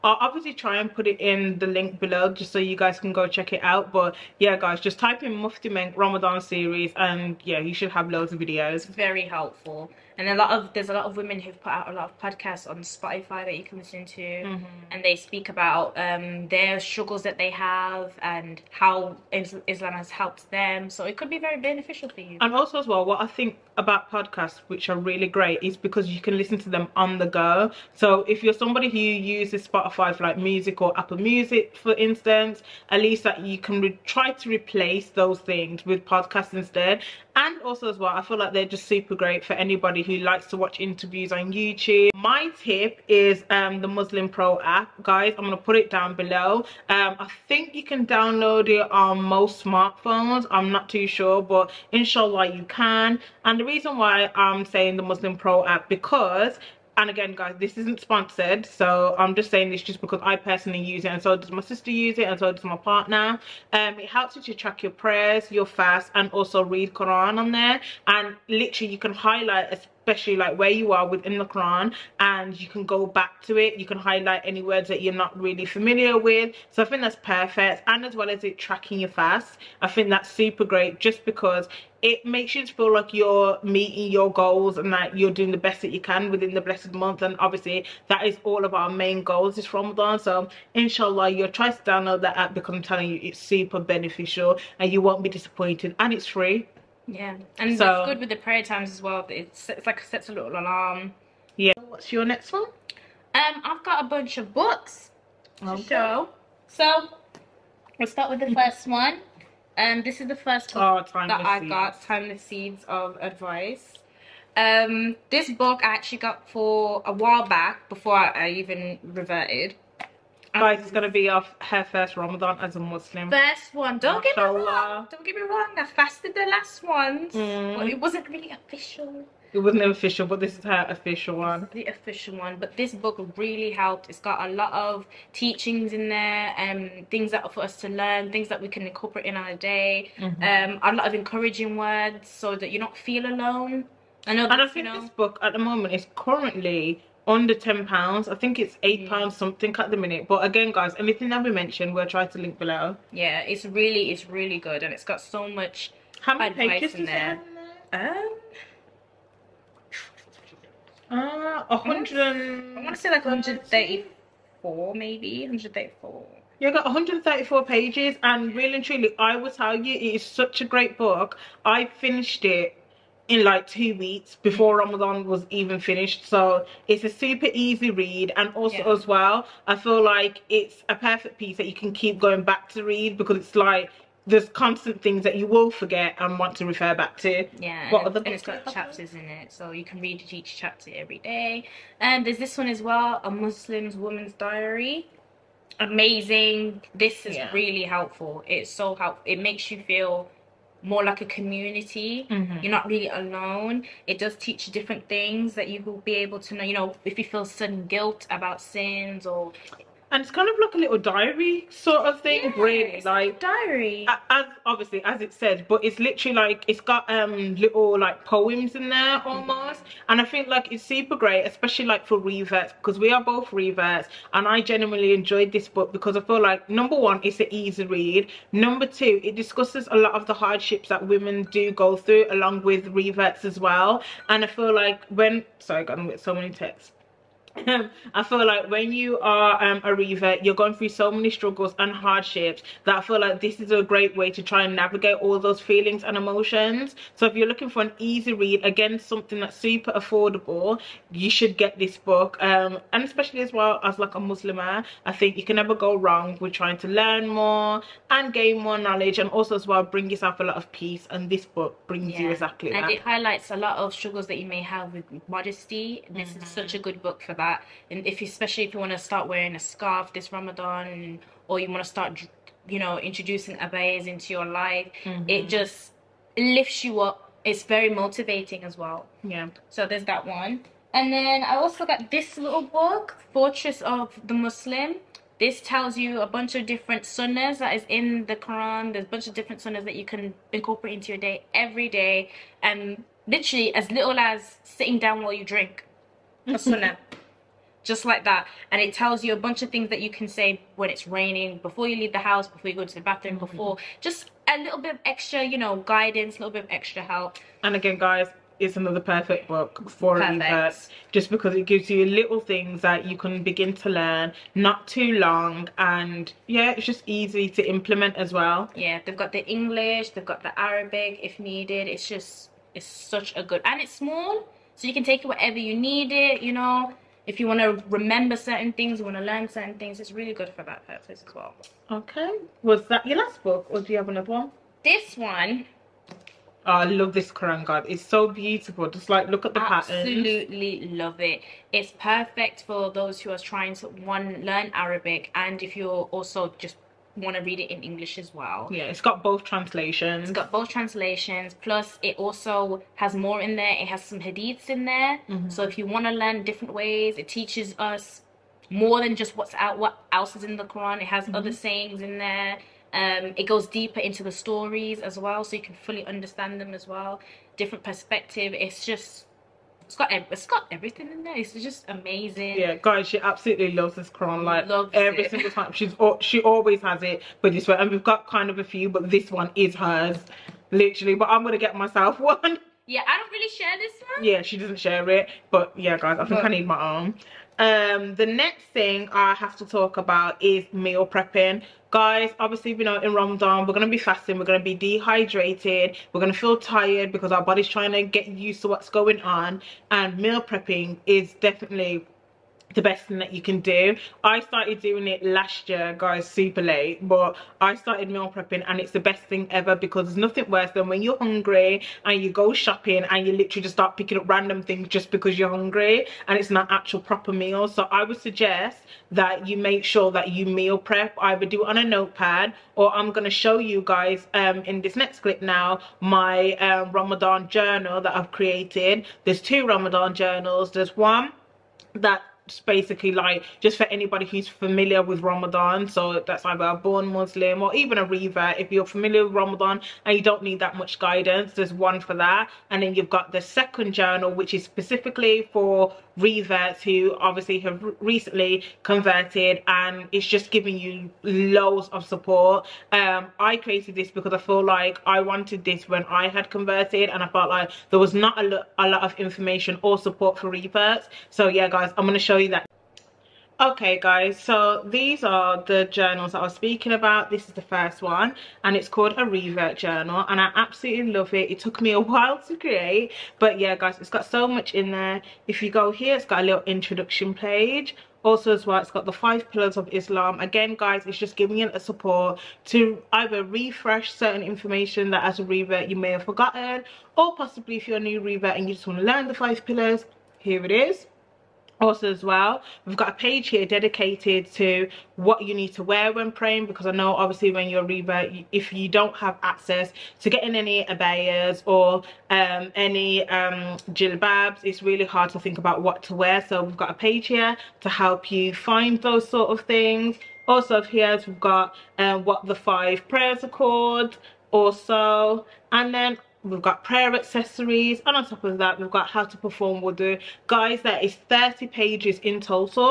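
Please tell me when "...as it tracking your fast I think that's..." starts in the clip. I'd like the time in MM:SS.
01:18.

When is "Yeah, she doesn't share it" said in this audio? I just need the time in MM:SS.
06:24.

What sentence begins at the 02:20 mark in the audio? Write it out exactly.
um, a lot of encouraging words so that you don't feel alone.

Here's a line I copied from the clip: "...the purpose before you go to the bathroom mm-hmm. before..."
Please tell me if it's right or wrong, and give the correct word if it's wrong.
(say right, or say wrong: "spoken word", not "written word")
wrong: "house", not "purpose".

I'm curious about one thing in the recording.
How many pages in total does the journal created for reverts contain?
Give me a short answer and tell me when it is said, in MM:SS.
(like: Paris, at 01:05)
30, at 08:41.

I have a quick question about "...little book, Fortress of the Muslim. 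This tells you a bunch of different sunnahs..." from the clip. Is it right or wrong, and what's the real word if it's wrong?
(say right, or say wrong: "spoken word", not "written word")
right.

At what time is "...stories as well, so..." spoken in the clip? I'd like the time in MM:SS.
06:04.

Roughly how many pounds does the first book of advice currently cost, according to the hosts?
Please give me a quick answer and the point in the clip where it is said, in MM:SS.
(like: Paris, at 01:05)
8, at 02:28.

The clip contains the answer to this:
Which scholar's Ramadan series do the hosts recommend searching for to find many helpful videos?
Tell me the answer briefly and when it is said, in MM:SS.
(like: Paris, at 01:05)
Mufti Menk, at 00:05.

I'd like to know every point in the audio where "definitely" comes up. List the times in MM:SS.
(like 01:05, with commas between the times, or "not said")
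06:41.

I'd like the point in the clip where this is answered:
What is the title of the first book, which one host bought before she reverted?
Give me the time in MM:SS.
01:52.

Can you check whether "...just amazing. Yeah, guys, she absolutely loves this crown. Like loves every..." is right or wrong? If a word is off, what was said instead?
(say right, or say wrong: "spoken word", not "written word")
right.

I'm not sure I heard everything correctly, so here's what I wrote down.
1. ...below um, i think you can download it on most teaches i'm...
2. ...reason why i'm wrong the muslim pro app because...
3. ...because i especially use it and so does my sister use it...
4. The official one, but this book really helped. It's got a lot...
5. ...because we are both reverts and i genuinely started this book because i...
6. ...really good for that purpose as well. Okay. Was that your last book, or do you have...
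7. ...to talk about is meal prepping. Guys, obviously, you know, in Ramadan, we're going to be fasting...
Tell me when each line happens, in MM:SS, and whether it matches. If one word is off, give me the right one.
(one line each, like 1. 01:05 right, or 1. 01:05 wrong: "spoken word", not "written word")
1. 00:46 wrong: "smartphones", not "teaches"
2. 00:53 wrong: "saying", not "wrong"
3. 01:00 wrong: "personally", not "especially"
4. 02:11 right
5. 03:42 wrong: "enjoyed", not "started"
6. 05:30 right
7. 06:29 right.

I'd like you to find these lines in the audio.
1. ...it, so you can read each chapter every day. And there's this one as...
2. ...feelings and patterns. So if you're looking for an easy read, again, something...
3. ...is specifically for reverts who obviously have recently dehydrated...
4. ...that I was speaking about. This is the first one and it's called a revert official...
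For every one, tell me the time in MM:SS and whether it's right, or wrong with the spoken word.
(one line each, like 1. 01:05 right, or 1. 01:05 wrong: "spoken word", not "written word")
1. 03:09 right
2. 04:05 wrong: "emotions", not "patterns"
3. 07:24 wrong: "converted", not "dehydrated"
4. 07:46 wrong: "journal", not "official".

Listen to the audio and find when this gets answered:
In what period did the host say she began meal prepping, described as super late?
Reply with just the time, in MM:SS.
06:45.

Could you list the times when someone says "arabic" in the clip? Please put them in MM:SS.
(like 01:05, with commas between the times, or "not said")
05:20, 05:44.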